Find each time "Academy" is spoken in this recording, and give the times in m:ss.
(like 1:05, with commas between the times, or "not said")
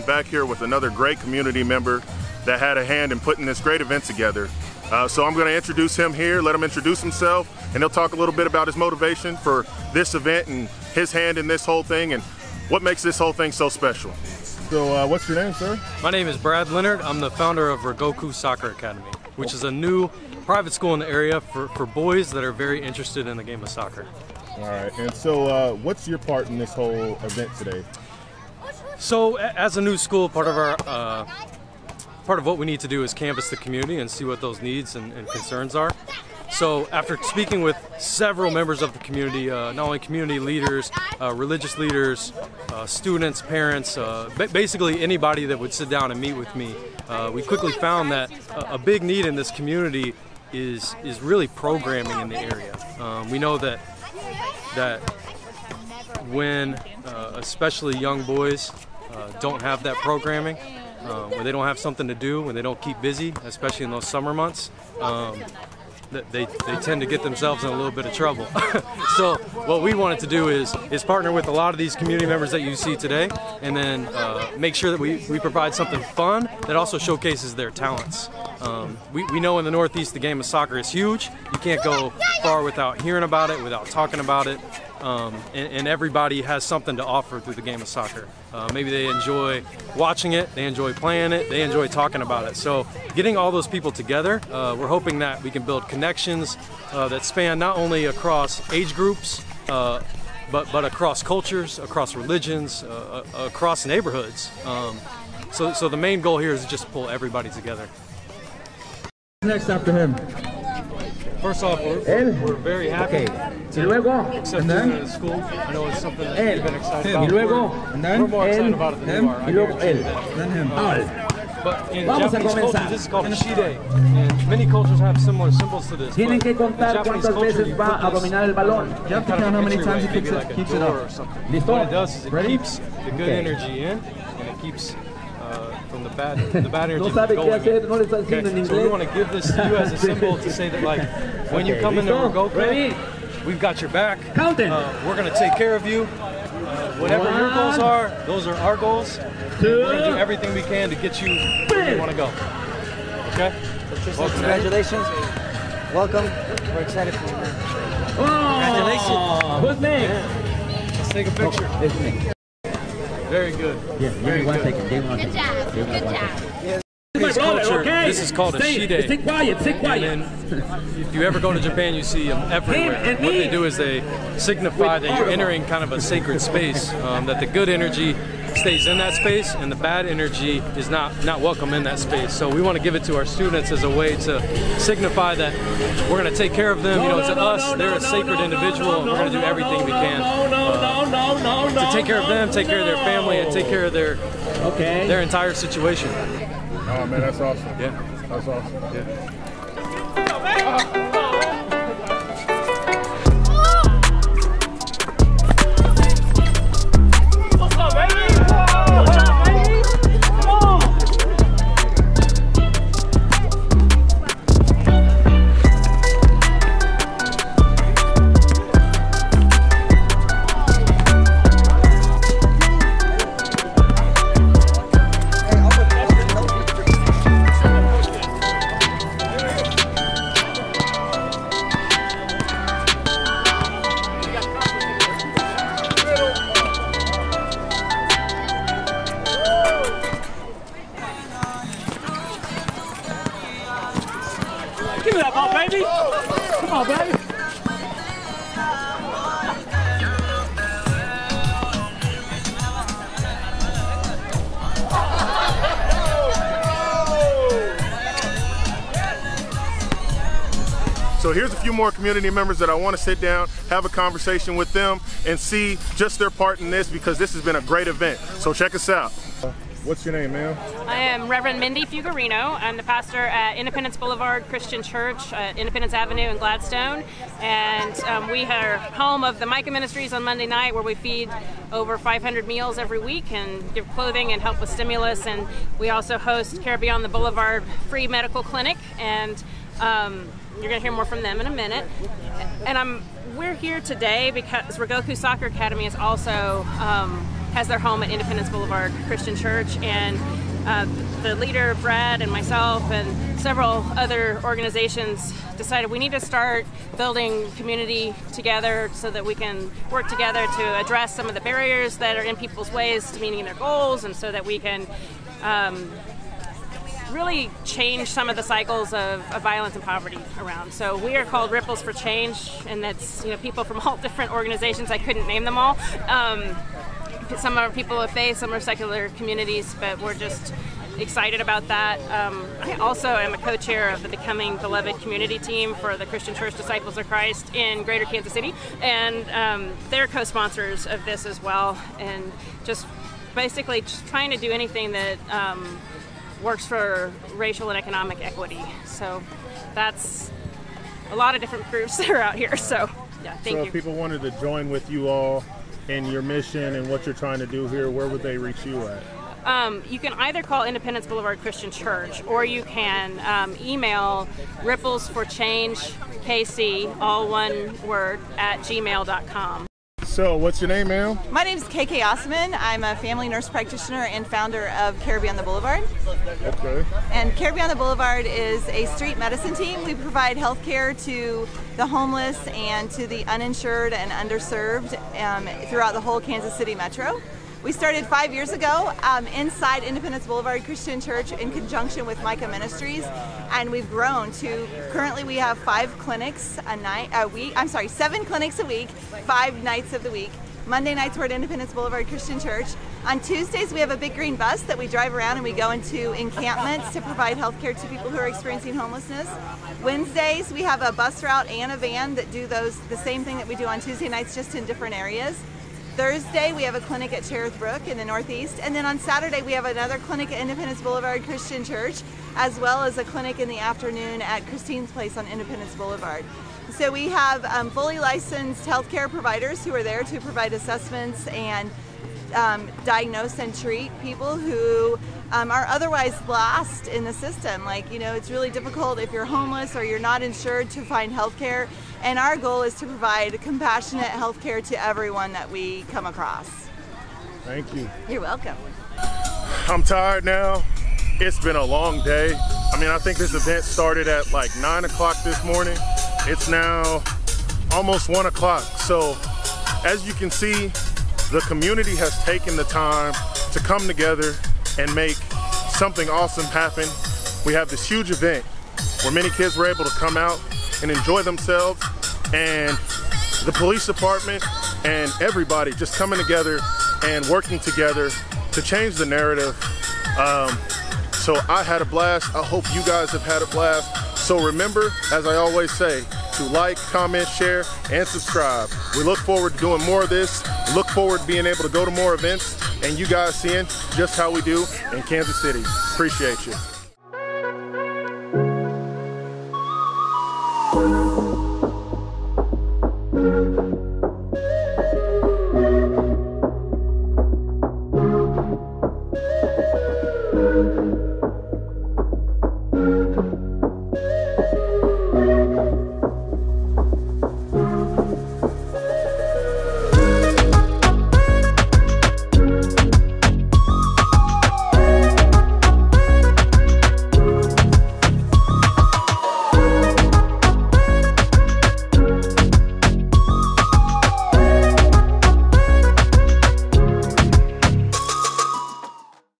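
0:18, 4:55.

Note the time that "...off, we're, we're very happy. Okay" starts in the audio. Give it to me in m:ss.
1:51.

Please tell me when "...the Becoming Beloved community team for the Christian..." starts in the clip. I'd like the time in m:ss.
5:34.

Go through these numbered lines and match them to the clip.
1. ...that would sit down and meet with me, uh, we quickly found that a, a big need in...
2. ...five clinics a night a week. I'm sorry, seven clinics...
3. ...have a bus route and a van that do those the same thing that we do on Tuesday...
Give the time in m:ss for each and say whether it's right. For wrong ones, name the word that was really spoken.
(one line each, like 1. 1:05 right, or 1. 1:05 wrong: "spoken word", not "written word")
1. 0:45 right
2. 6:35 right
3. 6:50 right.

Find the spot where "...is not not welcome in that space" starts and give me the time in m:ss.
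3:00.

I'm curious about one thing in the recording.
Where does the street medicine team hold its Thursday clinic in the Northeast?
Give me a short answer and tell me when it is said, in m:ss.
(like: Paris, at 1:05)
Cherith Brook, at 6:57.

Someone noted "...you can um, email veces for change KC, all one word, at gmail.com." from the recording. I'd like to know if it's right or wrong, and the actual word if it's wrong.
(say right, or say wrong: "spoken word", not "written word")
wrong: "ripples", not "veces".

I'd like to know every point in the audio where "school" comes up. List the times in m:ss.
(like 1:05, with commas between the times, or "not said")
0:20, 0:29.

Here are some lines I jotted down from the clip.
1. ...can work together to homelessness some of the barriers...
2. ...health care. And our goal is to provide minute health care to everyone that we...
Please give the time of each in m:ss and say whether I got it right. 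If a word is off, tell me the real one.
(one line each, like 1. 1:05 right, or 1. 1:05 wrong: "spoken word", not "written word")
1. 5:09 wrong: "address", not "homelessness"
2. 7:21 wrong: "compassionate", not "minute".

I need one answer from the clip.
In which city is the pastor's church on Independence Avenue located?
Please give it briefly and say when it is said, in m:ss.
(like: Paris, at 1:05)
Gladstone, at 4:36.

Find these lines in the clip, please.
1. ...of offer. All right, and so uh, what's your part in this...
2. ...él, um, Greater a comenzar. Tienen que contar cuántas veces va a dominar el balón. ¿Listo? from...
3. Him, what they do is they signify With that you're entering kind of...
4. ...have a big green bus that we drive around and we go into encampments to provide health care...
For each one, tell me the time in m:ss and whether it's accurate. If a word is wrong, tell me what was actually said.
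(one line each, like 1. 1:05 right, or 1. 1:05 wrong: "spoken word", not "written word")
1. 0:23 wrong: "soccer", not "offer"
2. 1:59 wrong: "Vamos", not "Greater"
3. 2:53 right
4. 6:43 right.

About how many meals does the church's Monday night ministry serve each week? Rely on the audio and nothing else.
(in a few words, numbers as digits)
500.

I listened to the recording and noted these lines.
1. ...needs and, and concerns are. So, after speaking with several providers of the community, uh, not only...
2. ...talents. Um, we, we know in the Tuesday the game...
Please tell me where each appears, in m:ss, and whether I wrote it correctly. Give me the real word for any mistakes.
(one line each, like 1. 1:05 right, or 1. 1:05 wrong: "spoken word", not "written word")
1. 0:34 wrong: "members", not "providers"
2. 1:17 wrong: "Northeast", not "Tuesday".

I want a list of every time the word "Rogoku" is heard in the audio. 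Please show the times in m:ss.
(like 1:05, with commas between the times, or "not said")
0:17, 4:54.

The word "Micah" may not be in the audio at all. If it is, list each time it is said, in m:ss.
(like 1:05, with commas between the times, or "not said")
4:39, 6:32.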